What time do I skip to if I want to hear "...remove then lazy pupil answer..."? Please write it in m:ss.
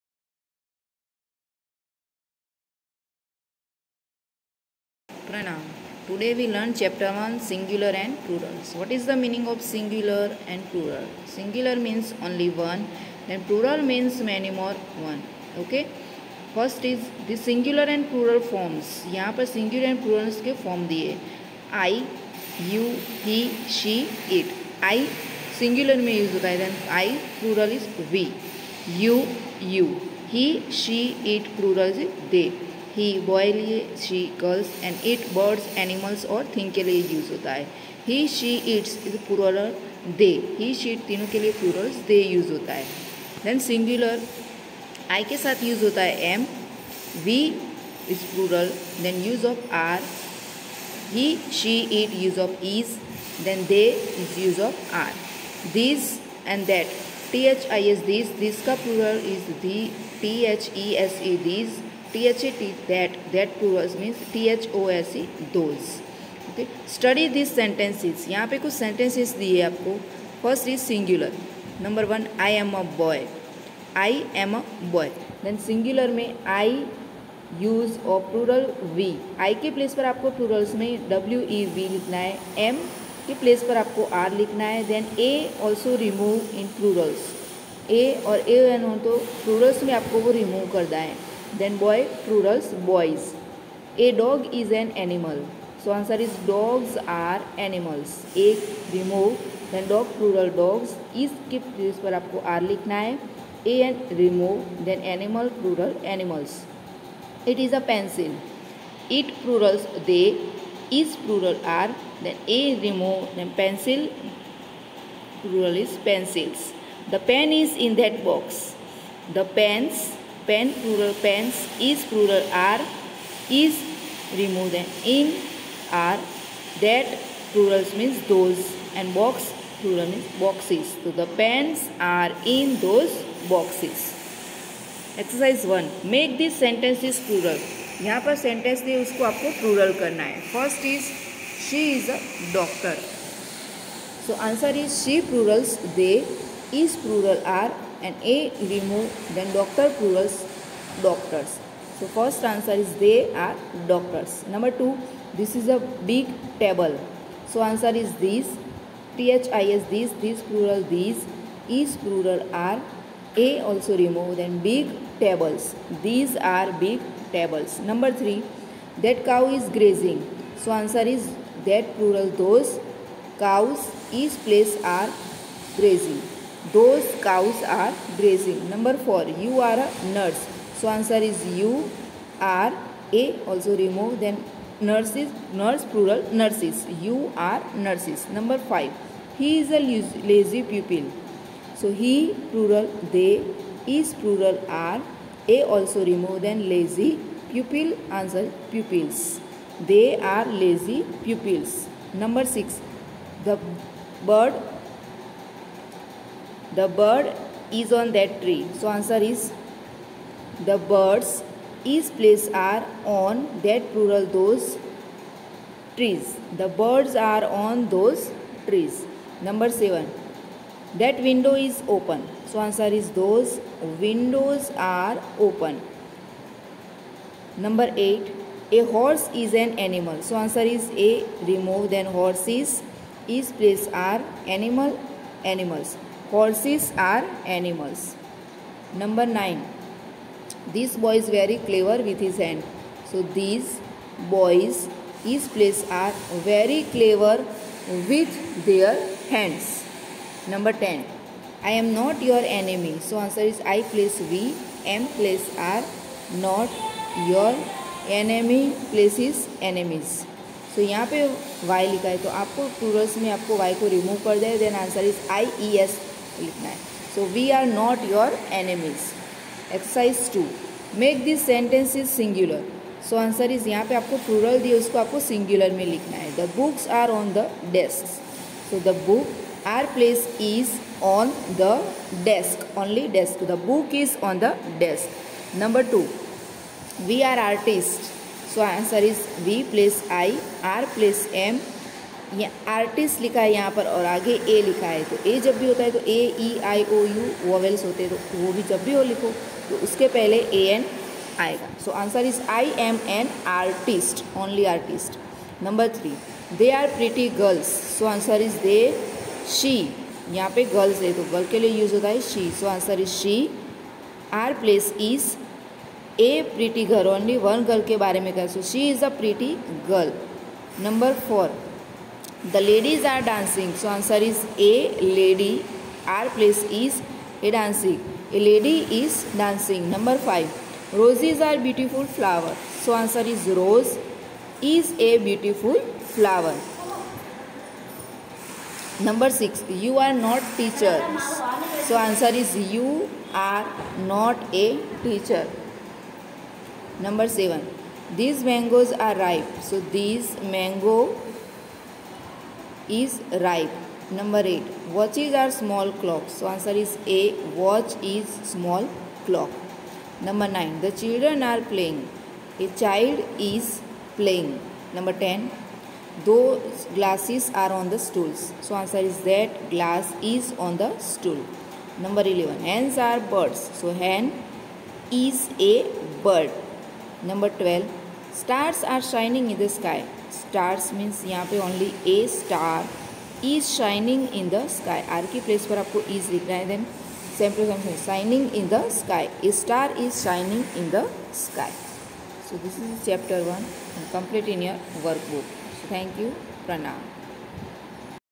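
3:16.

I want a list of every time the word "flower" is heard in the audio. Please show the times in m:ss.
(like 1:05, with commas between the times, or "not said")
5:32, 5:36.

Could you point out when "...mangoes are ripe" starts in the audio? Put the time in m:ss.
5:48.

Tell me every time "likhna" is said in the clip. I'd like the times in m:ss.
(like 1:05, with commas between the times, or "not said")
1:42.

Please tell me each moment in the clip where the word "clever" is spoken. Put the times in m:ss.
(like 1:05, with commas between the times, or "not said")
4:01, 4:06.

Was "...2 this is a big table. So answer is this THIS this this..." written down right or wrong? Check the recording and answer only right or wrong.
right.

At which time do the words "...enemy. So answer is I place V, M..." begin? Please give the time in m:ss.
4:12.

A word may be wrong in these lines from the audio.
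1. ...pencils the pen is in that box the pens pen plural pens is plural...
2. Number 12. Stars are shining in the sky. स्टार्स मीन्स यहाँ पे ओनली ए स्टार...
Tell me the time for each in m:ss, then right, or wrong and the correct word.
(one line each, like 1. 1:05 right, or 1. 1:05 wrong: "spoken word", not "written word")
1. 1:56 right
2. 6:17 right.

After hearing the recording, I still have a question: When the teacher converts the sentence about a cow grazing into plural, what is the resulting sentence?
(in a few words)
Those cows are grazing.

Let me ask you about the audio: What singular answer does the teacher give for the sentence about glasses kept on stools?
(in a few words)
That glass is on the stool.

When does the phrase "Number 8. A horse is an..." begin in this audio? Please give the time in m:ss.
3:47.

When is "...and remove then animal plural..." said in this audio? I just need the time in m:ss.
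1:43.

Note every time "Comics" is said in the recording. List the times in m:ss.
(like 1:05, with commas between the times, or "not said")
not said.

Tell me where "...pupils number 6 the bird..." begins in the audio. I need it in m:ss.
3:21.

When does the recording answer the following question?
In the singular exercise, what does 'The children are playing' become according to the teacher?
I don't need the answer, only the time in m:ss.
6:02.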